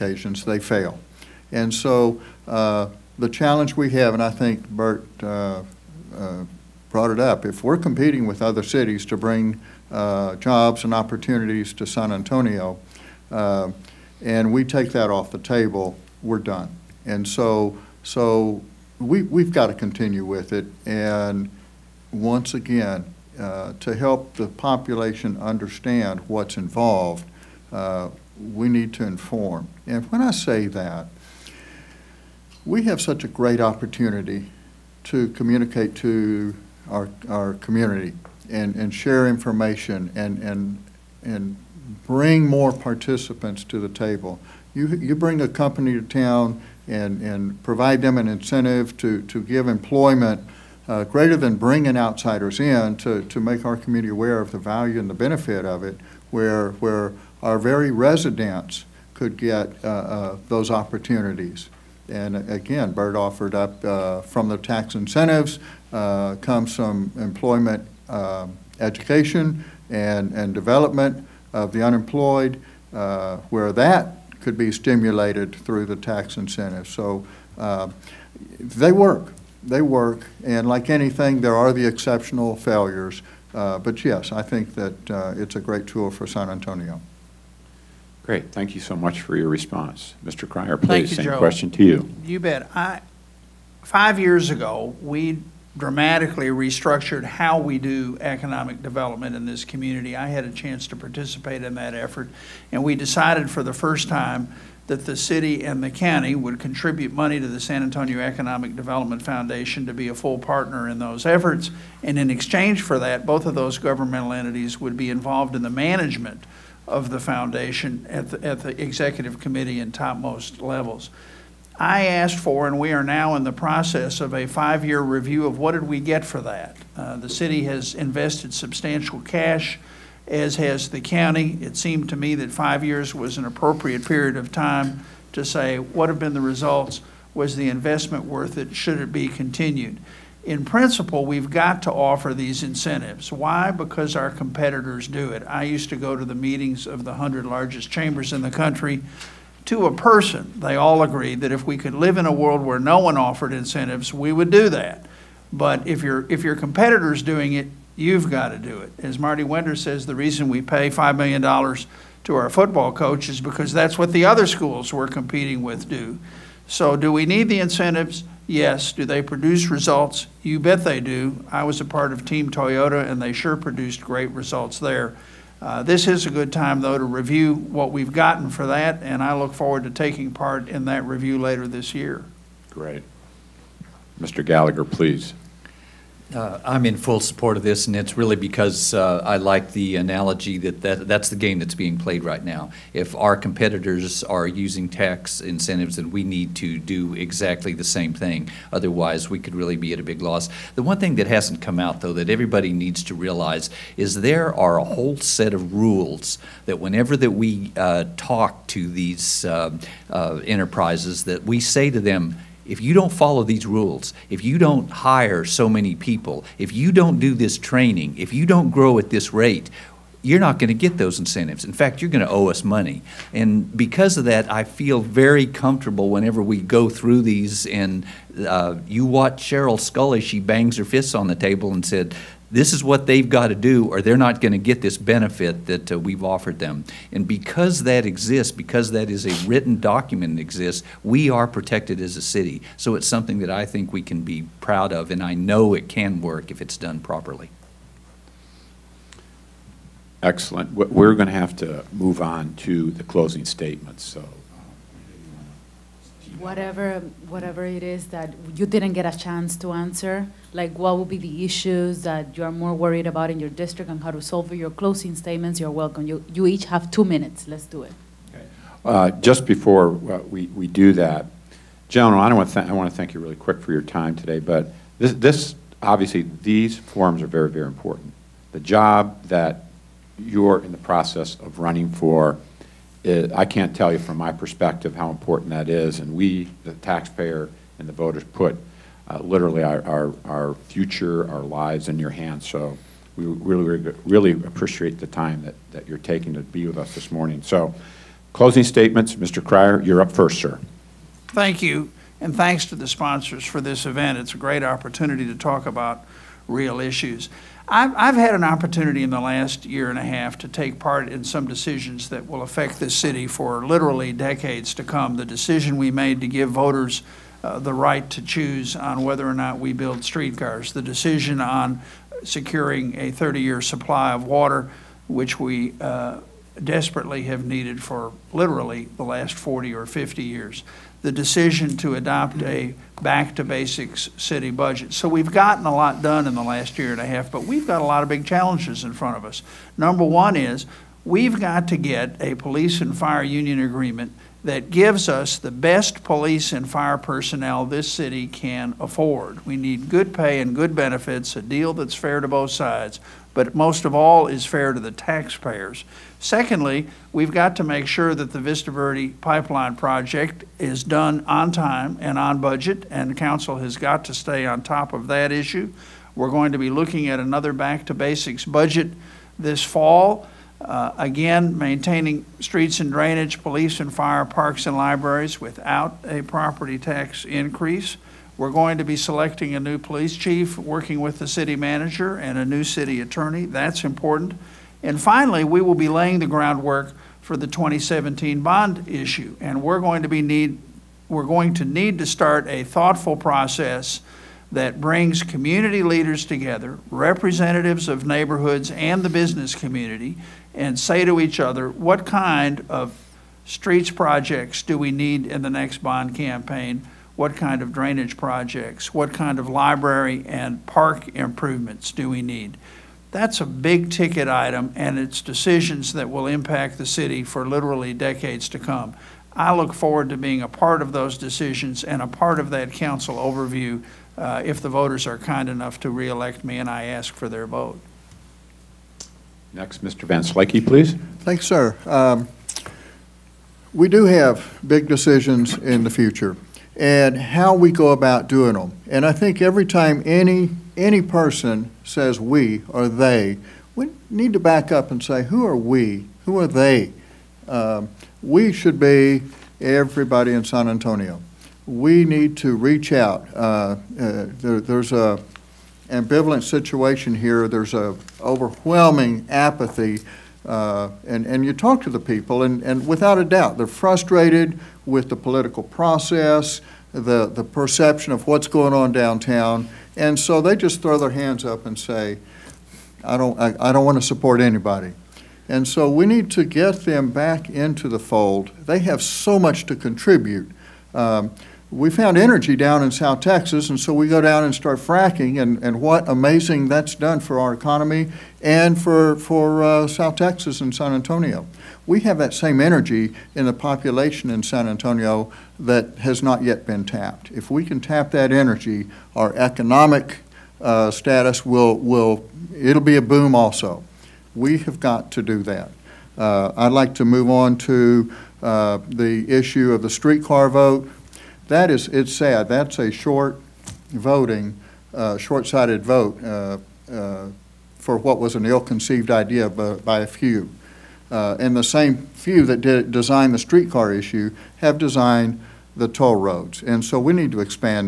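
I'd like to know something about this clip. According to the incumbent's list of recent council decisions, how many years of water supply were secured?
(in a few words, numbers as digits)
30.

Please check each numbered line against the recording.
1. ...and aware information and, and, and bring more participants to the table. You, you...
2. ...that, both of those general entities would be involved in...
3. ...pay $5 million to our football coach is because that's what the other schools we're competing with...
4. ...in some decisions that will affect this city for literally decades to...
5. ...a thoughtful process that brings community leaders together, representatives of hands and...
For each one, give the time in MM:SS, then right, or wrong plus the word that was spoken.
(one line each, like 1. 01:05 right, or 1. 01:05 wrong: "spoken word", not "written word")
1. 00:38 wrong: "share", not "aware"
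2. 01:52 wrong: "governmental", not "general"
3. 02:40 right
4. 05:11 right
5. 06:32 wrong: "neighborhoods", not "hands".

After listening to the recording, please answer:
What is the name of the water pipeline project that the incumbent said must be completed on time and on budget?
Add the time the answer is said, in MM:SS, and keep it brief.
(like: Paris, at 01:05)
Vista Verde, at 05:58.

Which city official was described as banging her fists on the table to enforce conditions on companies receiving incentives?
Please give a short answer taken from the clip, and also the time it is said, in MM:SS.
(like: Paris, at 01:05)
Sheryl Sculley, at 03:49.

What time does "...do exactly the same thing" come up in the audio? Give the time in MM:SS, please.
03:16.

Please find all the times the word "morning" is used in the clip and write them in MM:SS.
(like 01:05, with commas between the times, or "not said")
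04:57.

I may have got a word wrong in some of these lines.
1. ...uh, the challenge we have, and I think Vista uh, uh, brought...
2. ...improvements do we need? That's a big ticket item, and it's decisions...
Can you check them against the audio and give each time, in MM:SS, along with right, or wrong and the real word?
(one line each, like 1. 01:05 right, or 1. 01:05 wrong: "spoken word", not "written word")
1. 00:02 wrong: "Bert", not "Vista"
2. 06:51 right.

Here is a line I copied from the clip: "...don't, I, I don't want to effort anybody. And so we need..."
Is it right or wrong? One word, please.
wrong.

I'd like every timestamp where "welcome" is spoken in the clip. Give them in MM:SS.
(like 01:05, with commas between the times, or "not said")
04:25.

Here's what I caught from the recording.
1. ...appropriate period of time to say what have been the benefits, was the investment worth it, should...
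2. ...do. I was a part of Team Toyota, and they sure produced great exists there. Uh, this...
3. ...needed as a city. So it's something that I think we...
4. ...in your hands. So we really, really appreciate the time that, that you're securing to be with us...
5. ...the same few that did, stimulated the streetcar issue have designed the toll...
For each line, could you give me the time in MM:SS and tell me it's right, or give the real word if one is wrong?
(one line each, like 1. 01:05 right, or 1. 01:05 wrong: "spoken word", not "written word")
1. 02:13 wrong: "results", not "benefits"
2. 02:51 wrong: "results", not "exists"
3. 04:01 wrong: "protected", not "needed"
4. 04:51 wrong: "taking", not "securing"
5. 08:41 wrong: "designed", not "stimulated".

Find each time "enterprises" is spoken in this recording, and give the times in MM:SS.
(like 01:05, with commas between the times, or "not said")
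03:30.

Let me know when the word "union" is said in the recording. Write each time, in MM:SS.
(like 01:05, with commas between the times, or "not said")
05:43.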